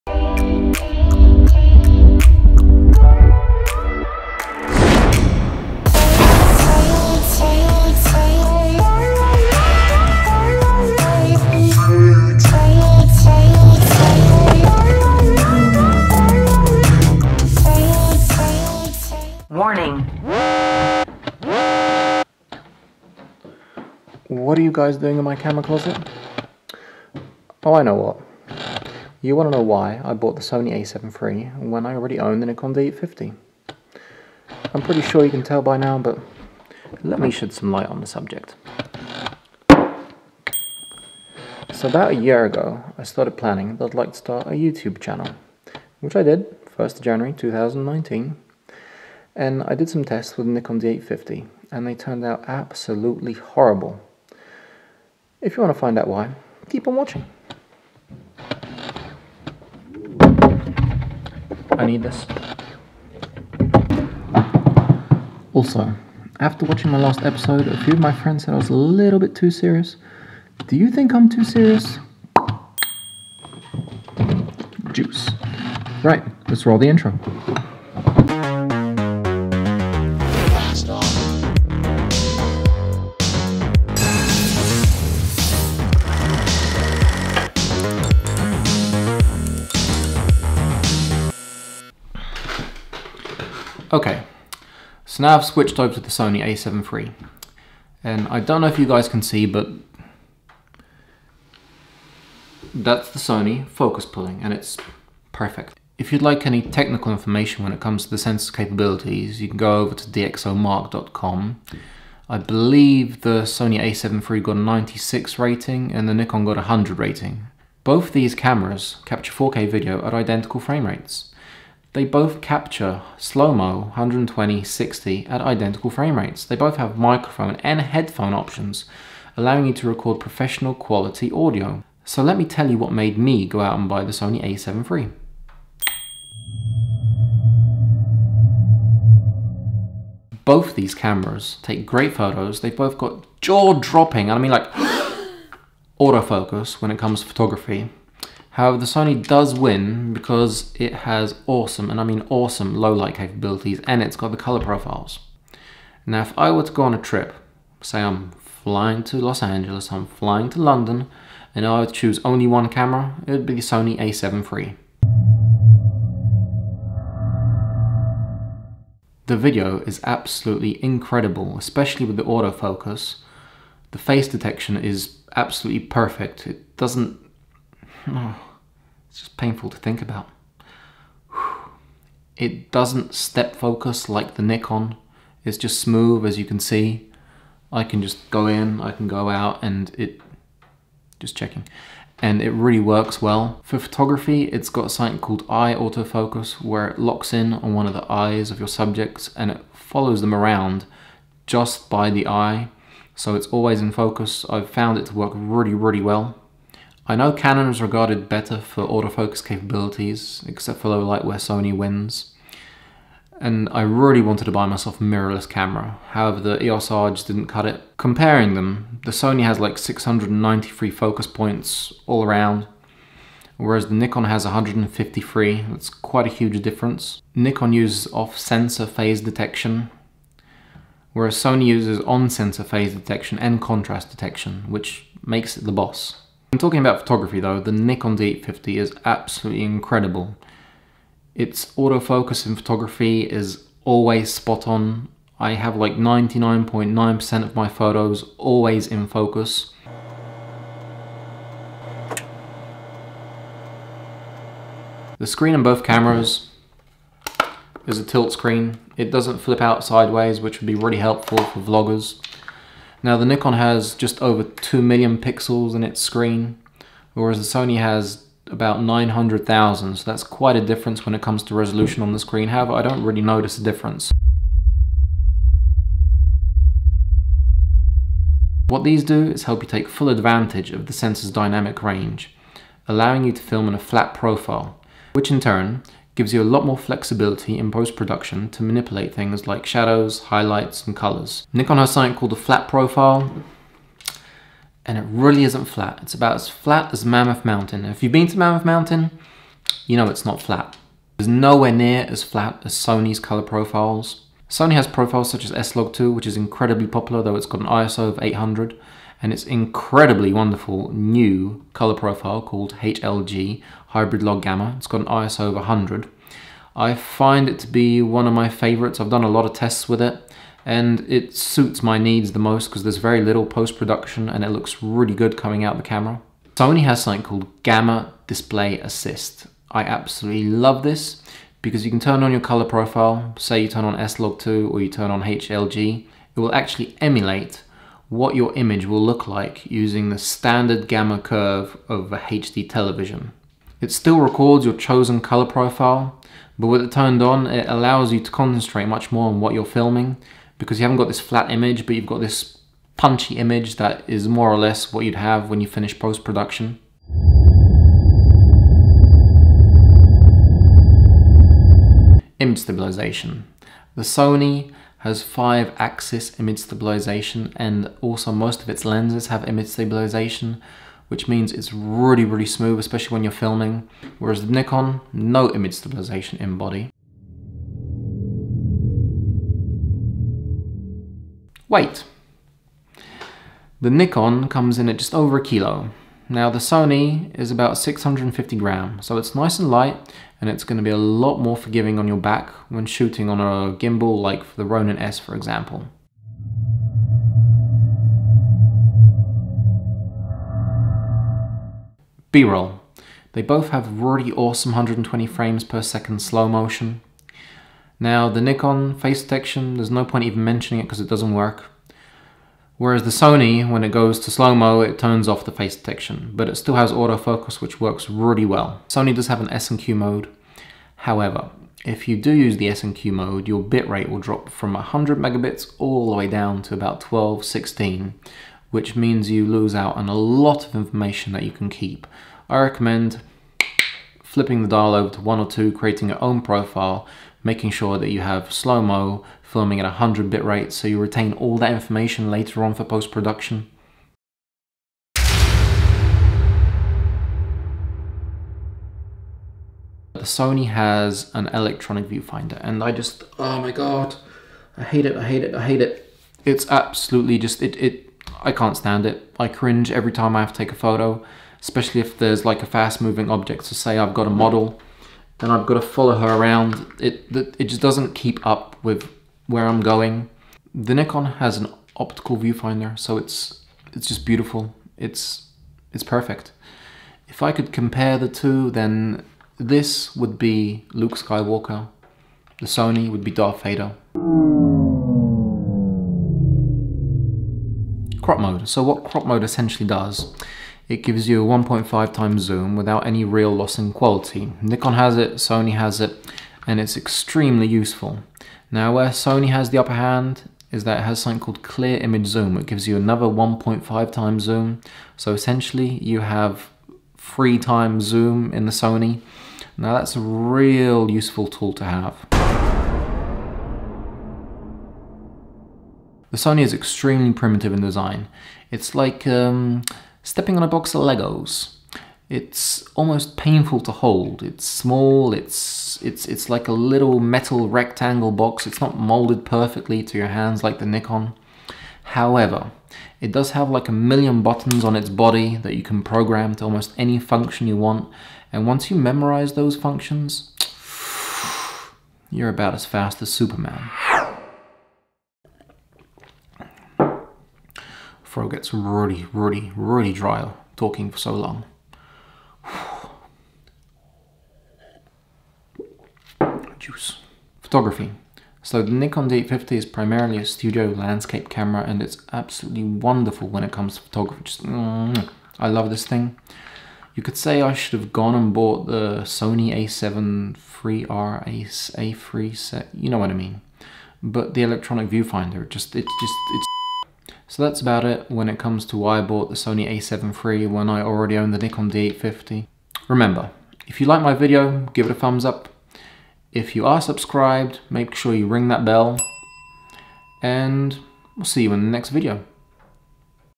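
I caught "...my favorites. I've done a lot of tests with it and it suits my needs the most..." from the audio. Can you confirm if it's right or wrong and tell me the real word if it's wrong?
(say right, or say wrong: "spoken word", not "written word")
right.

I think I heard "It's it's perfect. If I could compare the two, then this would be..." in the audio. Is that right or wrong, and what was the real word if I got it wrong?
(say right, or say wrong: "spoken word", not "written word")
right.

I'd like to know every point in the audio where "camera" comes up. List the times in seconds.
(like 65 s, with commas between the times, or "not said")
25 s, 118 s, 140 s, 162 s, 215 s, 255 s, 325 s, 561 s.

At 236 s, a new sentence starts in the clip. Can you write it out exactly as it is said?
I'm talking about photography though, the Nikon D850 is absolutely incredible.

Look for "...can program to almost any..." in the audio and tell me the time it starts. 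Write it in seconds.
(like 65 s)
535 s.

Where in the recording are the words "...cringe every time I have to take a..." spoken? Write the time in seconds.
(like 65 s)
459 s.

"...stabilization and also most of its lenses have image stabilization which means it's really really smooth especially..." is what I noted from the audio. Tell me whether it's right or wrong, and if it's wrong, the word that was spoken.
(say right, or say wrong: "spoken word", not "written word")
right.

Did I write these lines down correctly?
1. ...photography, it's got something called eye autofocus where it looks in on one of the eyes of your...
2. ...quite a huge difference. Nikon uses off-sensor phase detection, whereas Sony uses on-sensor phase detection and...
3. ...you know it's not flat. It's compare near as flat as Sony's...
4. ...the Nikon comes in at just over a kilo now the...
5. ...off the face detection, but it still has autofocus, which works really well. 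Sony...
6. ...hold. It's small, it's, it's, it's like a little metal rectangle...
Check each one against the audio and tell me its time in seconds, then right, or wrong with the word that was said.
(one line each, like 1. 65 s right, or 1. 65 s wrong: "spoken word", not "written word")
1. 193 s wrong: "locks", not "looks"
2. 225 s right
3. 299 s wrong: "nowhere", not "compare"
4. 383 s right
5. 415 s right
6. 523 s right.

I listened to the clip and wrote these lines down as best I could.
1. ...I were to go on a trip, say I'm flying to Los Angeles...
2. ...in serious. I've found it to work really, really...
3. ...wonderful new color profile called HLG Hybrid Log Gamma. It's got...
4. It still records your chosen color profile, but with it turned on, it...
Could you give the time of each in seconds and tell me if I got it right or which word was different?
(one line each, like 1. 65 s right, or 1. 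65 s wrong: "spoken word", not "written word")
1. 156 s right
2. 203 s wrong: "focus", not "serious"
3. 310 s right
4. 343 s right.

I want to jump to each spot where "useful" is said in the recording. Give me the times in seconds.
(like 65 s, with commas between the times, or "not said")
497 s, 511 s.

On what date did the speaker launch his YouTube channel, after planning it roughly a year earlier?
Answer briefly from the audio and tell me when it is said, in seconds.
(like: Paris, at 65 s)
1 January 2019, at 46 s.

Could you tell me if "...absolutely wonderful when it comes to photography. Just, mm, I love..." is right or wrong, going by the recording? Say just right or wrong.
right.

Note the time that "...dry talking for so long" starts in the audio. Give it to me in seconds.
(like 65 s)
550 s.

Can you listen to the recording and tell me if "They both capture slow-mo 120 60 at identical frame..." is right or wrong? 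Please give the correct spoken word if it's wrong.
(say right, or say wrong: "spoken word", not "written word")
right.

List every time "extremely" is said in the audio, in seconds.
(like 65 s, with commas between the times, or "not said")
496 s, 516 s.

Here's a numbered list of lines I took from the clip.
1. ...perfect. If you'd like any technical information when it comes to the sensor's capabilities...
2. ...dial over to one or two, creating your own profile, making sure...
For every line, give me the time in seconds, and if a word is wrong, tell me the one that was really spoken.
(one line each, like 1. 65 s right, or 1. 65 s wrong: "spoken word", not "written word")
1. 105 s right
2. 434 s right.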